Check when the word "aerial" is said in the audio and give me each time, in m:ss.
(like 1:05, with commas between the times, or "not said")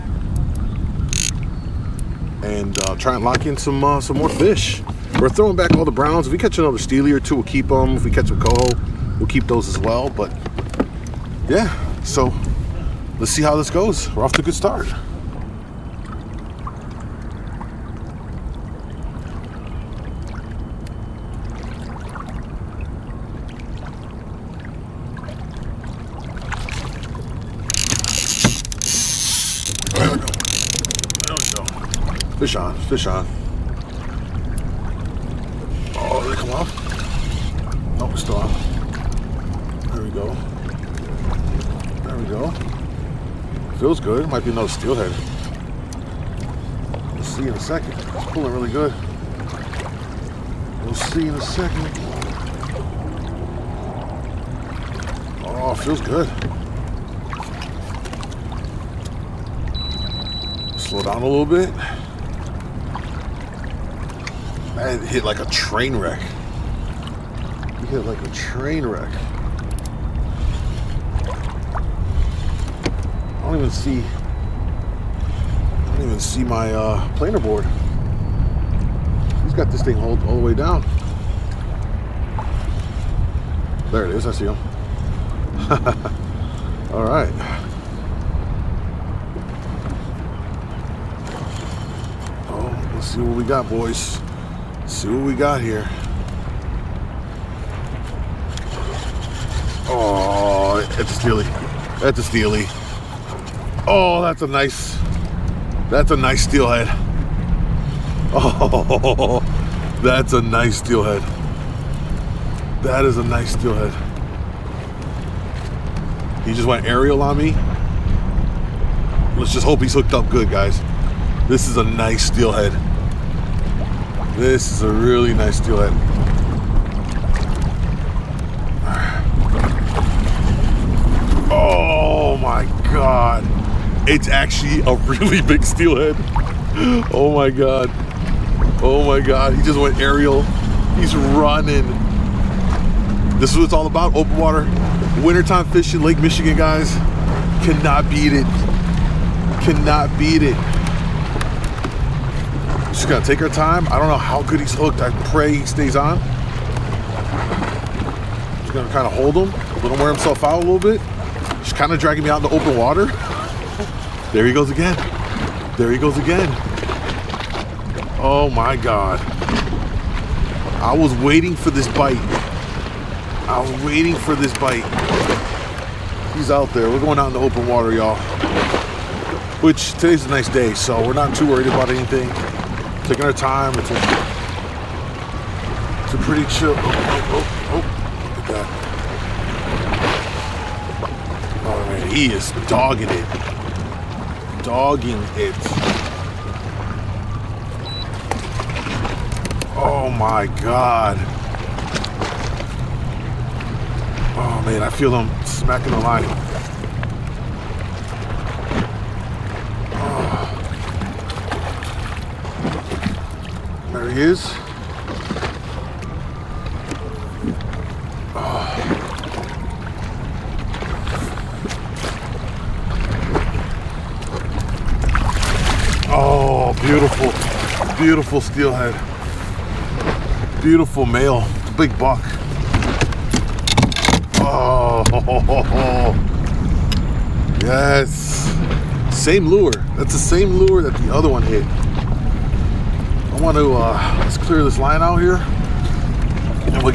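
1:56, 2:19.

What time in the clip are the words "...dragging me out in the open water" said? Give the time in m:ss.
2:41.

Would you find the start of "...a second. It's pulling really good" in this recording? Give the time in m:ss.
0:47.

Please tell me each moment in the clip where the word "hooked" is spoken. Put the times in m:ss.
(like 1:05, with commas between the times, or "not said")
1:59, 2:34.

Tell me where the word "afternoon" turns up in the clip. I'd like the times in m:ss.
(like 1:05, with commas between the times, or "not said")
not said.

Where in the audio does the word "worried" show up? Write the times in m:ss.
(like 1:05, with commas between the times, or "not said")
3:01.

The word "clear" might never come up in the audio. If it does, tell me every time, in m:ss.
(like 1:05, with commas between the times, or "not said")
4:04.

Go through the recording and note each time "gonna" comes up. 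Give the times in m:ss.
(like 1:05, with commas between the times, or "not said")
2:33, 2:38.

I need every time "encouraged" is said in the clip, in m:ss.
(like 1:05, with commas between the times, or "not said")
not said.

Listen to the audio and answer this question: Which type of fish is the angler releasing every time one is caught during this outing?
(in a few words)
browns.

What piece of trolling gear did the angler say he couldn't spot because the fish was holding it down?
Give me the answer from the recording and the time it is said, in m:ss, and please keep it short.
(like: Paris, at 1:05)
planer board, at 1:17.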